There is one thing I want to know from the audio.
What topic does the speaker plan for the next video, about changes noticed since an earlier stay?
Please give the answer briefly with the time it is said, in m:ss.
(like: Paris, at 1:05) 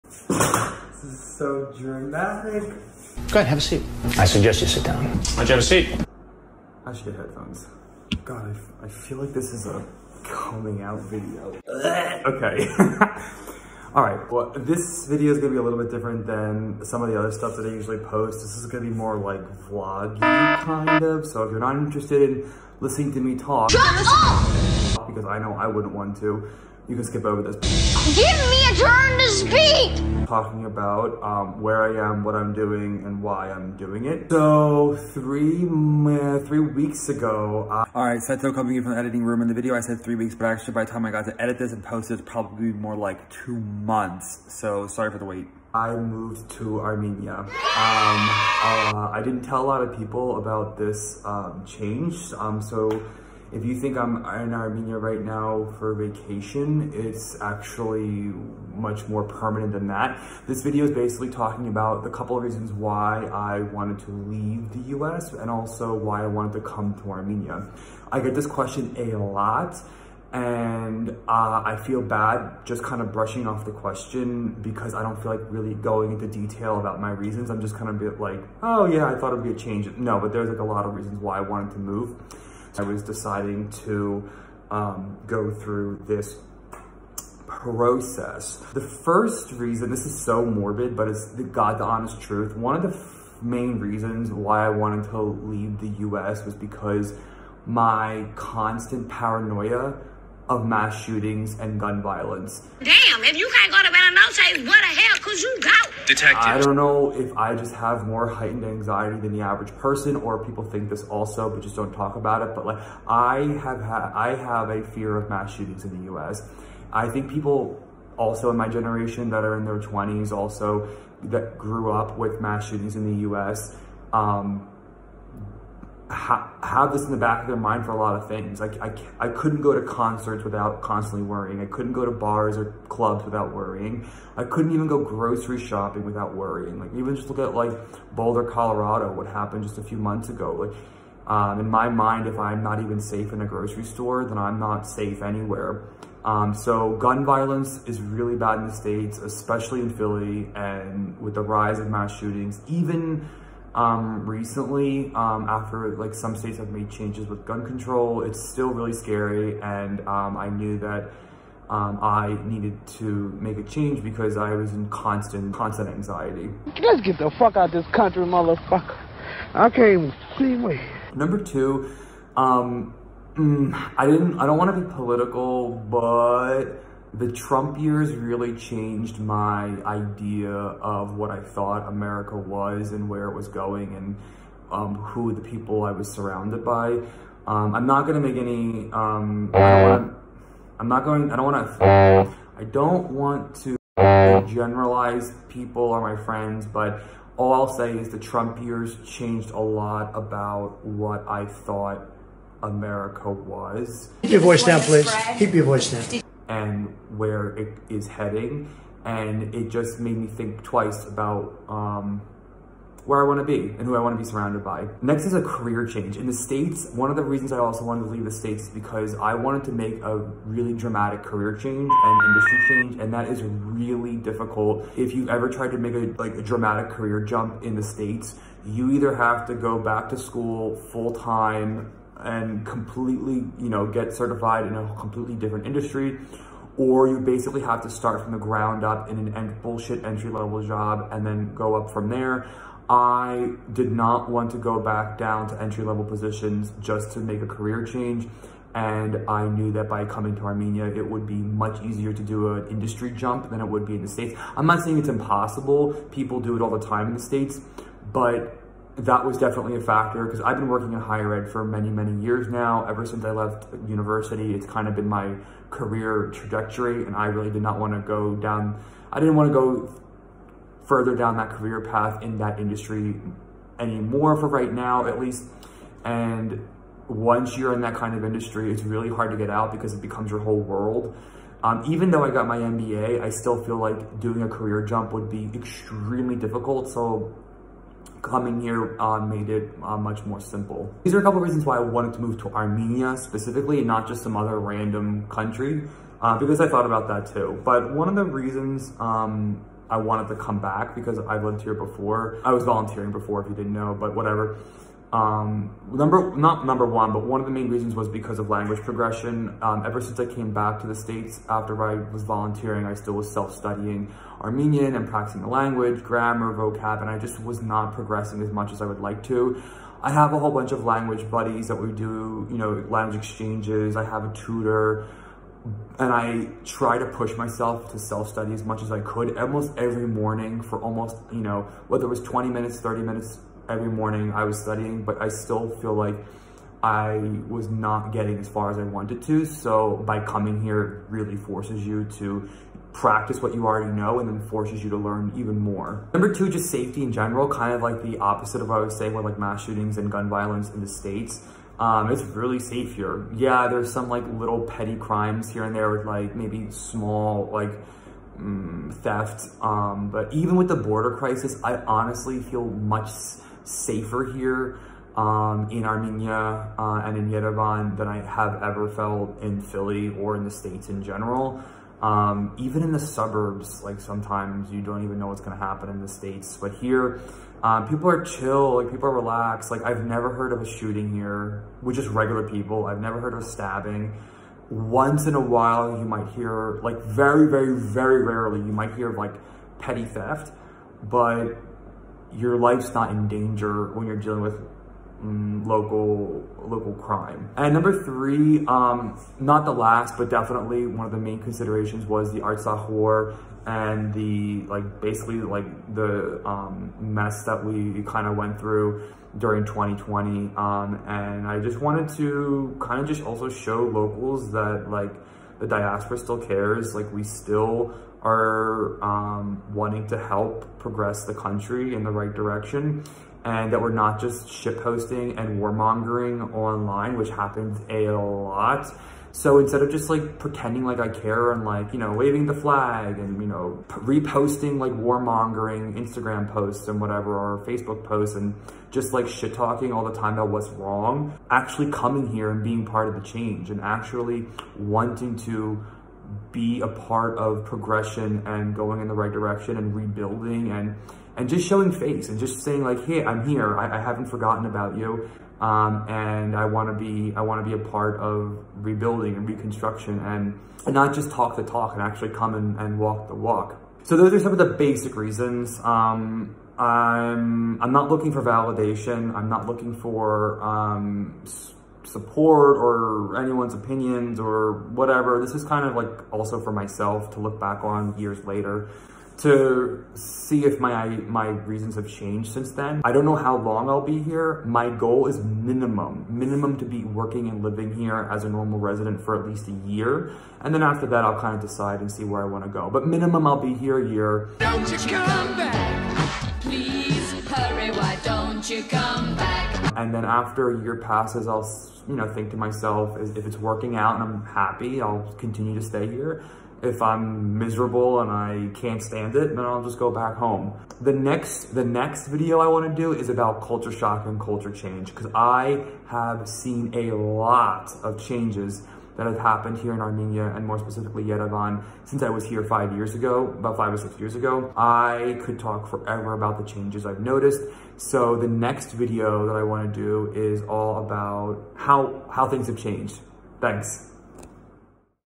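culture shock, at 8:33.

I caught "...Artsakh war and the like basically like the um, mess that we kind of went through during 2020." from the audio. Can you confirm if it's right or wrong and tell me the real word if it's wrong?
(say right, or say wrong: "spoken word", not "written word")
right.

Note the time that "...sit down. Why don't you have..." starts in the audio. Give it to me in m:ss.
0:04.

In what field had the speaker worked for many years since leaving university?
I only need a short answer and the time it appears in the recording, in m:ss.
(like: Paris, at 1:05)
higher ed, at 4:20.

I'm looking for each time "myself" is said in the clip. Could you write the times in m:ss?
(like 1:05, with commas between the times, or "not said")
5:27, 7:56, 8:22.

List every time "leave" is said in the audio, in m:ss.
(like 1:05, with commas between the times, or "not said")
1:04, 1:35, 3:38.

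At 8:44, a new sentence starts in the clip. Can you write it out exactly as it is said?
I could talk forever about the changes I've noticed.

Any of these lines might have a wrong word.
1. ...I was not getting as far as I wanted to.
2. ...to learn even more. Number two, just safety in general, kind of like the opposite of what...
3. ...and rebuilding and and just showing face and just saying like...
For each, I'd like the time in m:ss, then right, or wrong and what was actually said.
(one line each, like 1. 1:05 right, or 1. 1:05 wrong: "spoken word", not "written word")
1. 5:36 right
2. 5:44 right
3. 7:29 right.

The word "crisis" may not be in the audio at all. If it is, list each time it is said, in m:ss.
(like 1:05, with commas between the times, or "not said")
6:01.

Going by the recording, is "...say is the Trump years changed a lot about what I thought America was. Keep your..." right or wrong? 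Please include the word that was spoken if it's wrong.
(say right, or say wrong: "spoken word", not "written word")
right.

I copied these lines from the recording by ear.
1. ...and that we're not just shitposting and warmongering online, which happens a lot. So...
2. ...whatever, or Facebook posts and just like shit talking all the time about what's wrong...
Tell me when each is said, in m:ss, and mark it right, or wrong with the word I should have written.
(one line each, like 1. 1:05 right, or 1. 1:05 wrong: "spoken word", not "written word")
1. 7:03 right
2. 7:17 right.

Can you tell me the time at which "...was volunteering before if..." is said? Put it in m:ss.
5:02.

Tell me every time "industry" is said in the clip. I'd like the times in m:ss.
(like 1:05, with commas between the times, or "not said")
3:42, 3:55, 4:12, 4:32, 4:38.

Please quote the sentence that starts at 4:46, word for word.
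So coming here uh, made it uh, much more simple.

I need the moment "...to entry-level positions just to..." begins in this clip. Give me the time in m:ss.
4:05.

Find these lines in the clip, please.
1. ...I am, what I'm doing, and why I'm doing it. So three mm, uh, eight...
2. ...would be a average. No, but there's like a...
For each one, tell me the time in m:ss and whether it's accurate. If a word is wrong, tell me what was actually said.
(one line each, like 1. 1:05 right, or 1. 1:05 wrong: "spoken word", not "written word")
1. 0:31 wrong: "three", not "eight"
2. 1:19 wrong: "change", not "average".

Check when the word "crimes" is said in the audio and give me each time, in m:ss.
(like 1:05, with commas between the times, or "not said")
5:54, 6:36.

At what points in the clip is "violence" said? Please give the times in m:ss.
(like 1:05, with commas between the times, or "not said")
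1:42, 2:27, 5:50.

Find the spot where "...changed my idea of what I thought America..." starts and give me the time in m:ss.
2:58.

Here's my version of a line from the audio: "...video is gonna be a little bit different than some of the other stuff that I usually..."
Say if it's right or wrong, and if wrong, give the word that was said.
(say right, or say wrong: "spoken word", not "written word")
right.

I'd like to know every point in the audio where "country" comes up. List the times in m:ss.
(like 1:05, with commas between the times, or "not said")
2:47, 4:55, 7:01.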